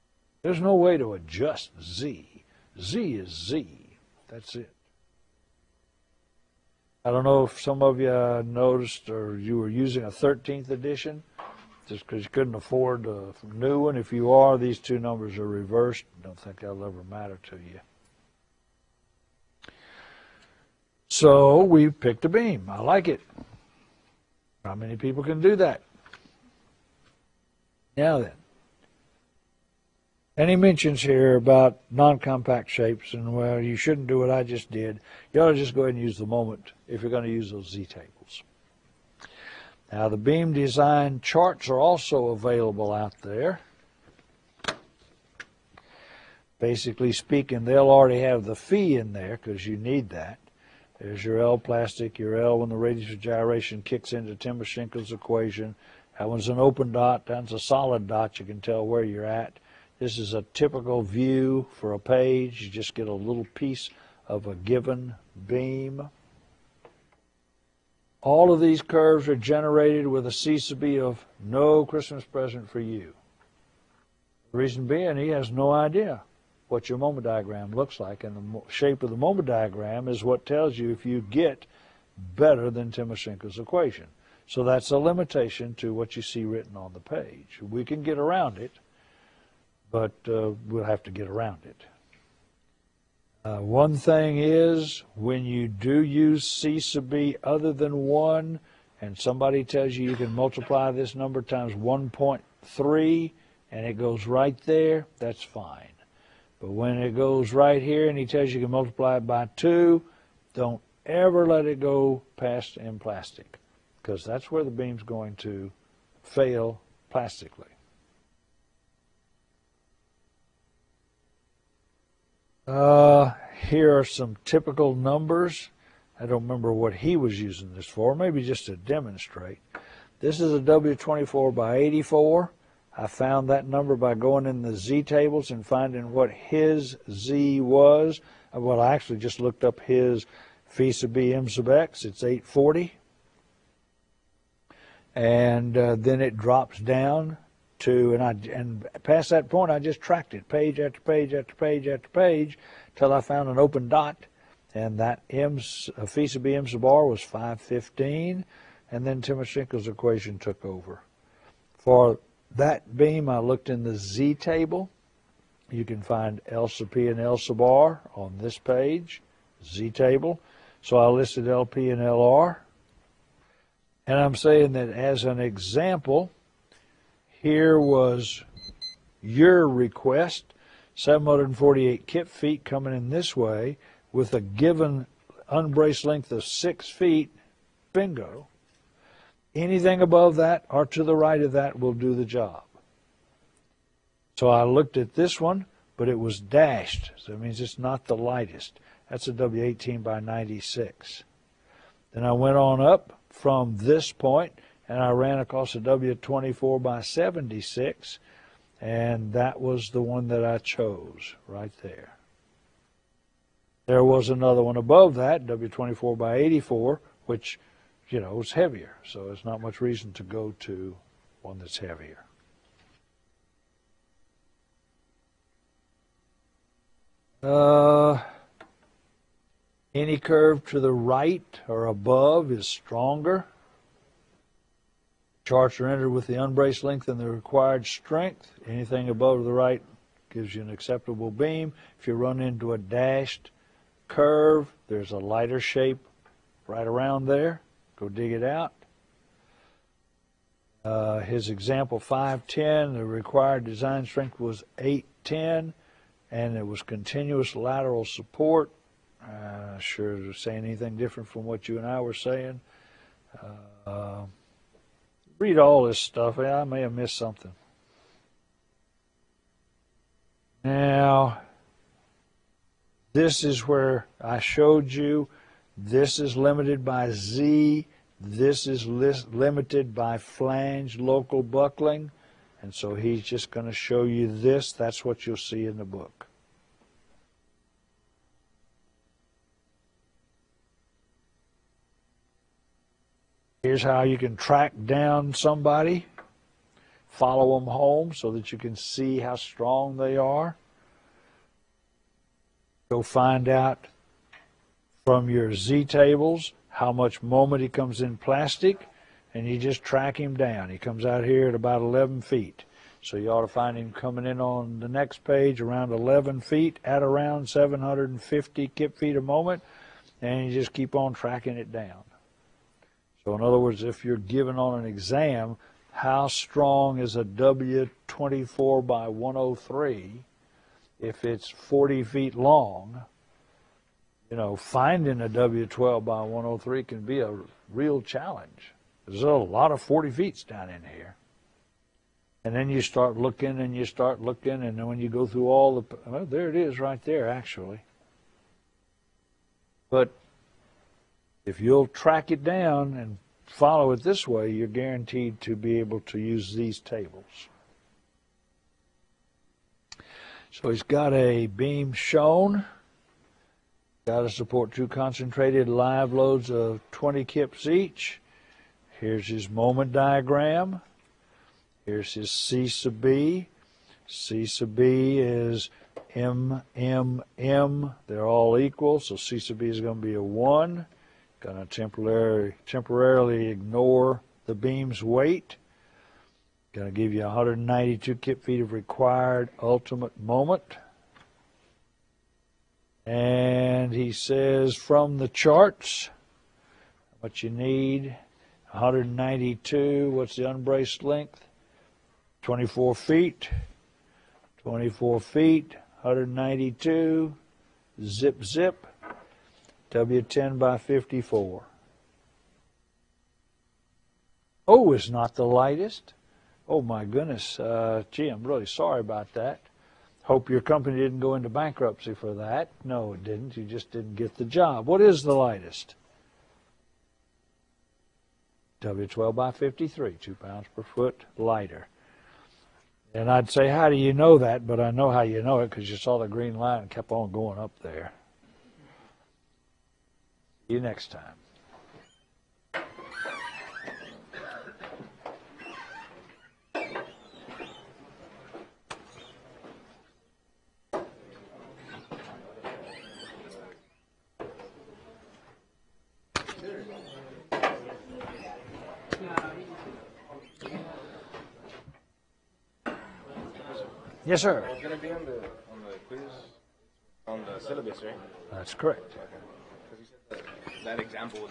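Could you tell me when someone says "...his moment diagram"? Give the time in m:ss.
6:09.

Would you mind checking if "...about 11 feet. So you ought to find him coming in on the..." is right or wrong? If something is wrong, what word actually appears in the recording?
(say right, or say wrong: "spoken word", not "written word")
right.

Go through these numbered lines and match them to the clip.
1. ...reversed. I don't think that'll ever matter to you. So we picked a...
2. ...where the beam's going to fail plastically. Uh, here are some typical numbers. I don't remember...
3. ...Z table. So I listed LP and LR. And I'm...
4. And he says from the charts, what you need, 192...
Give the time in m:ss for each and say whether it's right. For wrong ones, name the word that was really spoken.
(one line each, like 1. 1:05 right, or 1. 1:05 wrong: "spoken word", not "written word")
1. 0:15 right
2. 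1:54 right
3. 2:49 right
4. 6:33 right.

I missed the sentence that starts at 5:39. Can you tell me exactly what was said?
There's a lot of 40 feet down in here.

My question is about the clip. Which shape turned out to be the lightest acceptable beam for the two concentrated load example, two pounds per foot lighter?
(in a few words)
W12 by 53.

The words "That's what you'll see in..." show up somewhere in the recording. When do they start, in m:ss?
4:44.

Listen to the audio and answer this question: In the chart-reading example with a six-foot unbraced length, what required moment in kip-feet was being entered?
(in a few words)
748.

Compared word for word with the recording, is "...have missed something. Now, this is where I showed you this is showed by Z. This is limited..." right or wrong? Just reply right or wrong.
wrong.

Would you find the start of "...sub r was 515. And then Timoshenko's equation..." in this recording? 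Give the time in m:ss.
2:36.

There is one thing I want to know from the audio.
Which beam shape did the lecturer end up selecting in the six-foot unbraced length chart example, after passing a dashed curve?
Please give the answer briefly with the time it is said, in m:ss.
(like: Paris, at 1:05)
W24 by 76, at 3:25.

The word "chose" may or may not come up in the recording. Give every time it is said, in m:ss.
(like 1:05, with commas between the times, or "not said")
3:30.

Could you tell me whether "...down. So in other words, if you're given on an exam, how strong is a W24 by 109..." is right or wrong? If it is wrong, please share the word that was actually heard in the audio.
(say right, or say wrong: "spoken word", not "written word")
wrong: "103", not "109".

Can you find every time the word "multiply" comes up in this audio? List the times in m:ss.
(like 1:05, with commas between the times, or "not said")
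1:40, 1:48.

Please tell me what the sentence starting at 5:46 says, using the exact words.
Well, there it is right there, actually.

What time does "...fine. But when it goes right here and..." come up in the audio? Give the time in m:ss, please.
1:45.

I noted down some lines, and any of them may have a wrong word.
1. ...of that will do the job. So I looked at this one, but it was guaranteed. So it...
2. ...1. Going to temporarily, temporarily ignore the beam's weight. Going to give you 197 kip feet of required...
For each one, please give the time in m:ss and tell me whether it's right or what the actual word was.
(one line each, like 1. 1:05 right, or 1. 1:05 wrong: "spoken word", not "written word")
1. 3:11 wrong: "dashed", not "guaranteed"
2. 6:20 wrong: "192", not "197".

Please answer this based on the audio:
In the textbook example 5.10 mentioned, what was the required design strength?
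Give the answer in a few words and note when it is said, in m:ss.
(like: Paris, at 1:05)
810, at 4:14.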